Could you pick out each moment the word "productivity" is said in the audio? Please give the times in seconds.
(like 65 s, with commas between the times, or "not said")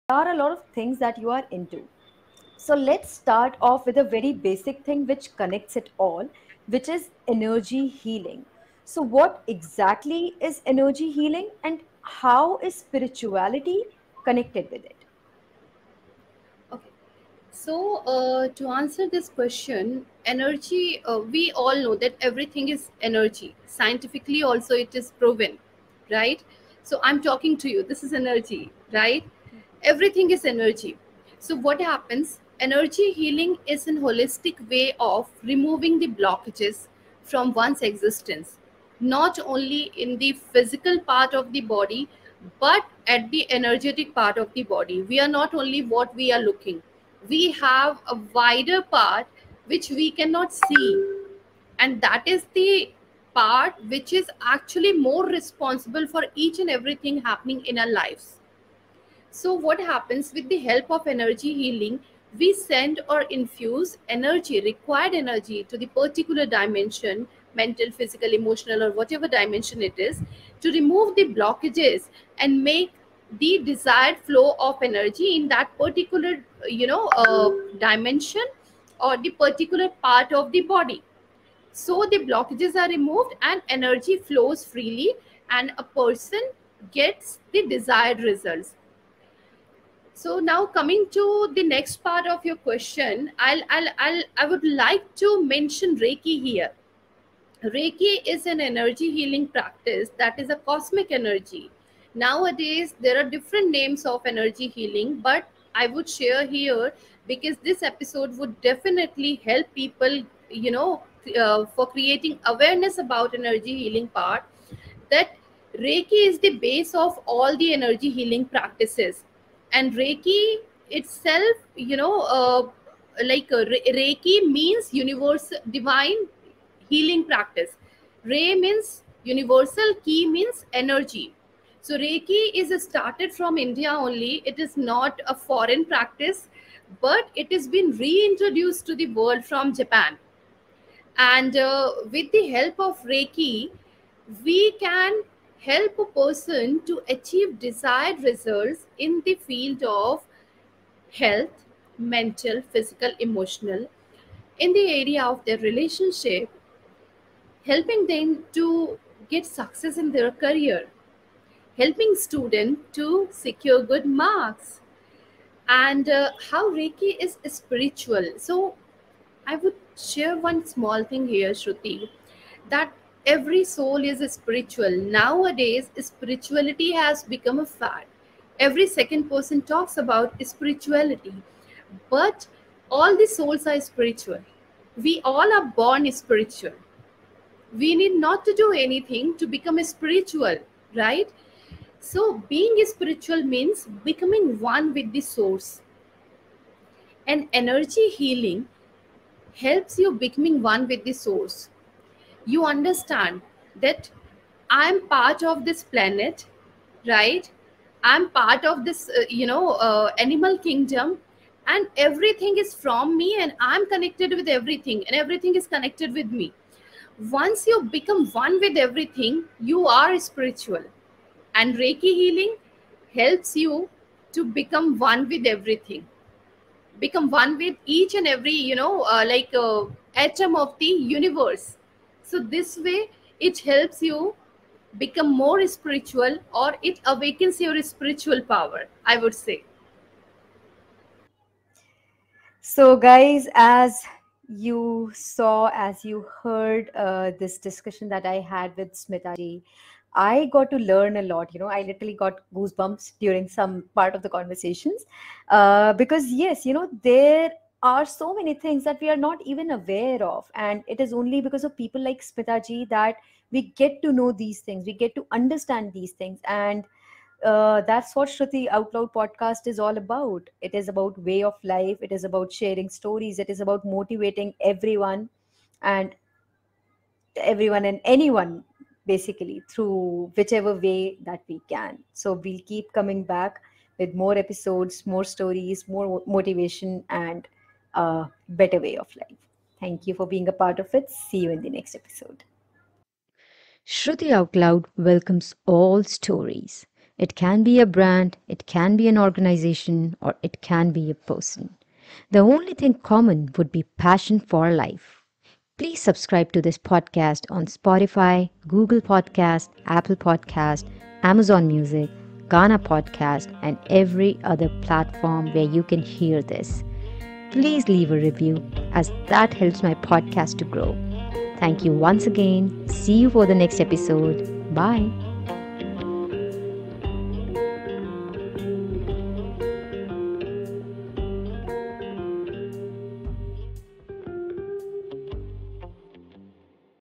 not said.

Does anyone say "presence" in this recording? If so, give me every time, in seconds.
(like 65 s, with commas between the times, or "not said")
not said.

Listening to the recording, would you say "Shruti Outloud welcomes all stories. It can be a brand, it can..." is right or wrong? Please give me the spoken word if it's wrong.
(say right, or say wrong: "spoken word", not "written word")
right.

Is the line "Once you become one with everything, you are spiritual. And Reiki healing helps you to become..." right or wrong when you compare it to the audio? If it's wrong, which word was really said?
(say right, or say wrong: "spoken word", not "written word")
right.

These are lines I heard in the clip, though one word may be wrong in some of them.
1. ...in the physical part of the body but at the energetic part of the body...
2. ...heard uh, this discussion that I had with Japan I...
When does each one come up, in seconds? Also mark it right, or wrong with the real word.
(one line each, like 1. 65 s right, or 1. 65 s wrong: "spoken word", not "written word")
1. 40 s right
2. 246 s wrong: "Smita", not "Japan".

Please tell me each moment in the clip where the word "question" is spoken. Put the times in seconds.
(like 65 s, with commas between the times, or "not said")
19 s, 92 s.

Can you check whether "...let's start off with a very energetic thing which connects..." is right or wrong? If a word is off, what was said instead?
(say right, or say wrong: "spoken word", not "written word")
wrong: "basic", not "energetic".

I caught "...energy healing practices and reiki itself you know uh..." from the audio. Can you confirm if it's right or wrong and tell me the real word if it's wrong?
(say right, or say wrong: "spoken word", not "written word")
right.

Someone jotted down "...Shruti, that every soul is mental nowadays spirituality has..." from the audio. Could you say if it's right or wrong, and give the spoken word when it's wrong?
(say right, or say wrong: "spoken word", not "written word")
wrong: "spiritual", not "mental".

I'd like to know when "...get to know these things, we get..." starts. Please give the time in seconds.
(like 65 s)
263 s.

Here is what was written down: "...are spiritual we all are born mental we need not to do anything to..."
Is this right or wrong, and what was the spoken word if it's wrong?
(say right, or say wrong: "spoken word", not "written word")
wrong: "spiritual", not "mental".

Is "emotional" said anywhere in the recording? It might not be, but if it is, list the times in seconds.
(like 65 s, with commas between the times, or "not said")
68 s, 153 s.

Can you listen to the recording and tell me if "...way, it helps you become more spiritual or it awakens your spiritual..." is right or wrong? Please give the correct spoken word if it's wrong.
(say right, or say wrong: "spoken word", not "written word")
right.